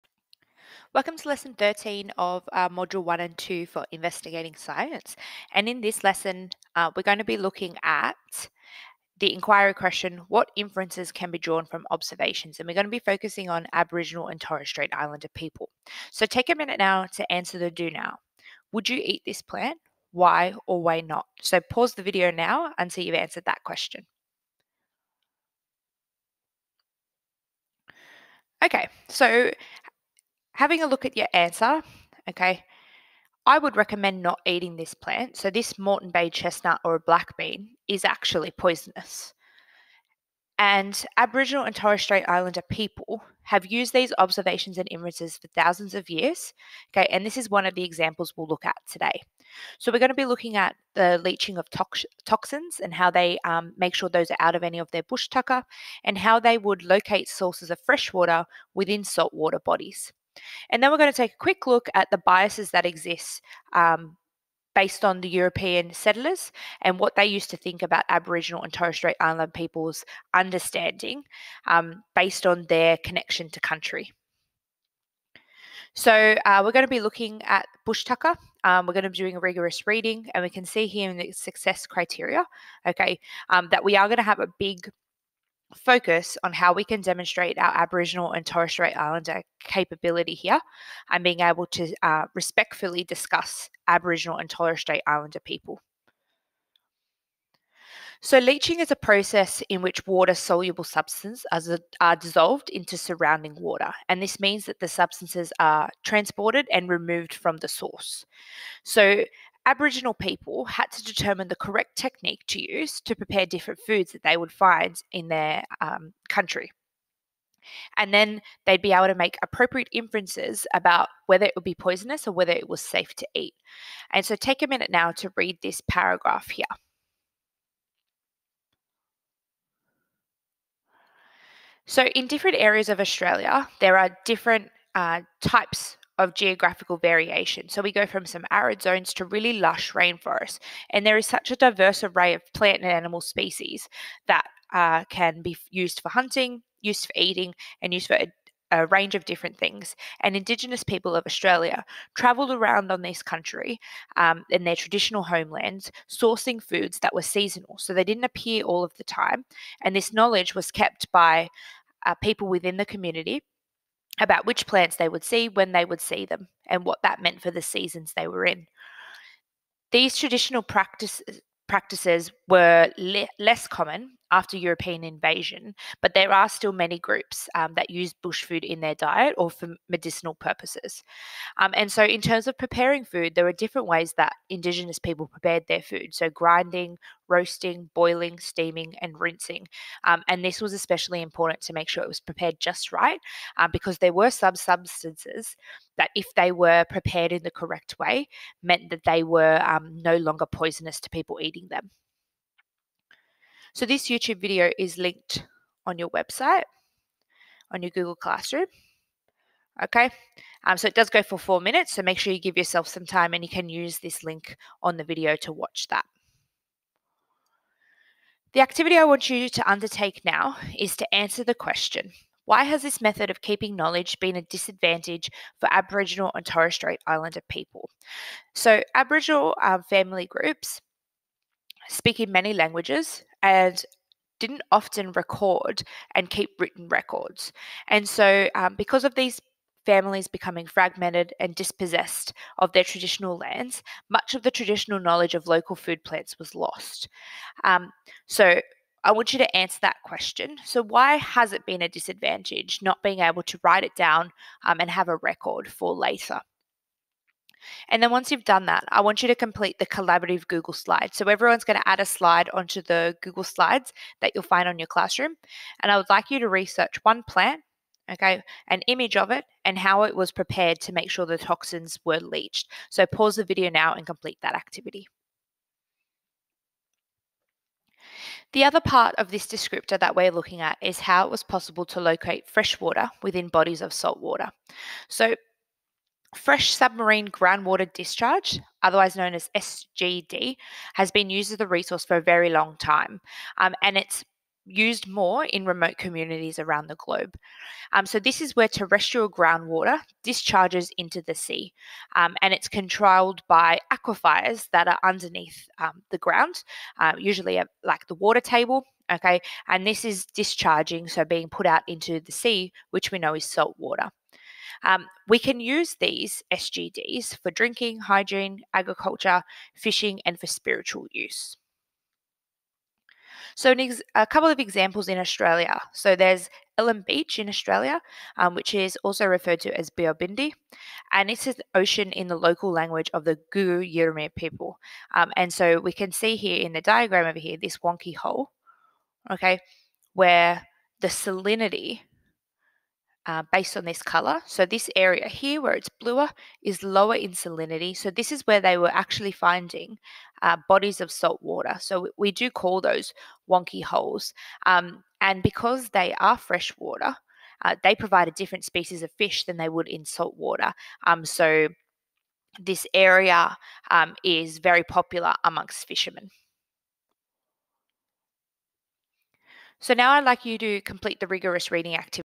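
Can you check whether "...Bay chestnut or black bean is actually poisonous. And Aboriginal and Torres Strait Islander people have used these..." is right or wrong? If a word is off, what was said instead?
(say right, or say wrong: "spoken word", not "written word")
right.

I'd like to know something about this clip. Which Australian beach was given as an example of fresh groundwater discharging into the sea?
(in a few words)
Ellen Beach.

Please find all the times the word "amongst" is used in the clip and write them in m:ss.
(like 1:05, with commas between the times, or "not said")
6:05.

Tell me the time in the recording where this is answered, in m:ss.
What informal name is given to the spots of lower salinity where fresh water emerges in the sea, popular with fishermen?
5:53.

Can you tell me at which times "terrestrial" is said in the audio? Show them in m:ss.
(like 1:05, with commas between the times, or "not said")
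4:58.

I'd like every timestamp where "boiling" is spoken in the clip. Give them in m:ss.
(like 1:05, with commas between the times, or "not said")
3:07.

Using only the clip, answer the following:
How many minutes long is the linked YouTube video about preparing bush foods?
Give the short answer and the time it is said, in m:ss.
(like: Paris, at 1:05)
4, at 3:31.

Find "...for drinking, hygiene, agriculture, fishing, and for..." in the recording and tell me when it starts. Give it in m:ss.
5:17.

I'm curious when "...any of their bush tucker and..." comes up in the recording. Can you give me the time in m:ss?
0:54.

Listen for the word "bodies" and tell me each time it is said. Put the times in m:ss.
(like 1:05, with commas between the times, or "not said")
0:59, 4:43, 5:50.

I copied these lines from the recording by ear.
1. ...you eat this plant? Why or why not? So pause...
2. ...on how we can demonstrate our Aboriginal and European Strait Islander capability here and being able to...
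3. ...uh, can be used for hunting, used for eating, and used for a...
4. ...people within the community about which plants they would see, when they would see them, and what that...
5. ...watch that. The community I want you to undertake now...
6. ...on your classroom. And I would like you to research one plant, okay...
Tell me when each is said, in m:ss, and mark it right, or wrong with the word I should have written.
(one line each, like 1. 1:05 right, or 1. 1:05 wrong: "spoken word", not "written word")
1. 0:18 right
2. 1:26 wrong: "Torres", not "European"
3. 2:24 right
4. 2:42 right
5. 3:35 wrong: "activity", not "community"
6. 4:24 right.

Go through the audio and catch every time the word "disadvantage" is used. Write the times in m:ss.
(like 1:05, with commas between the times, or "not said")
3:44, 4:11.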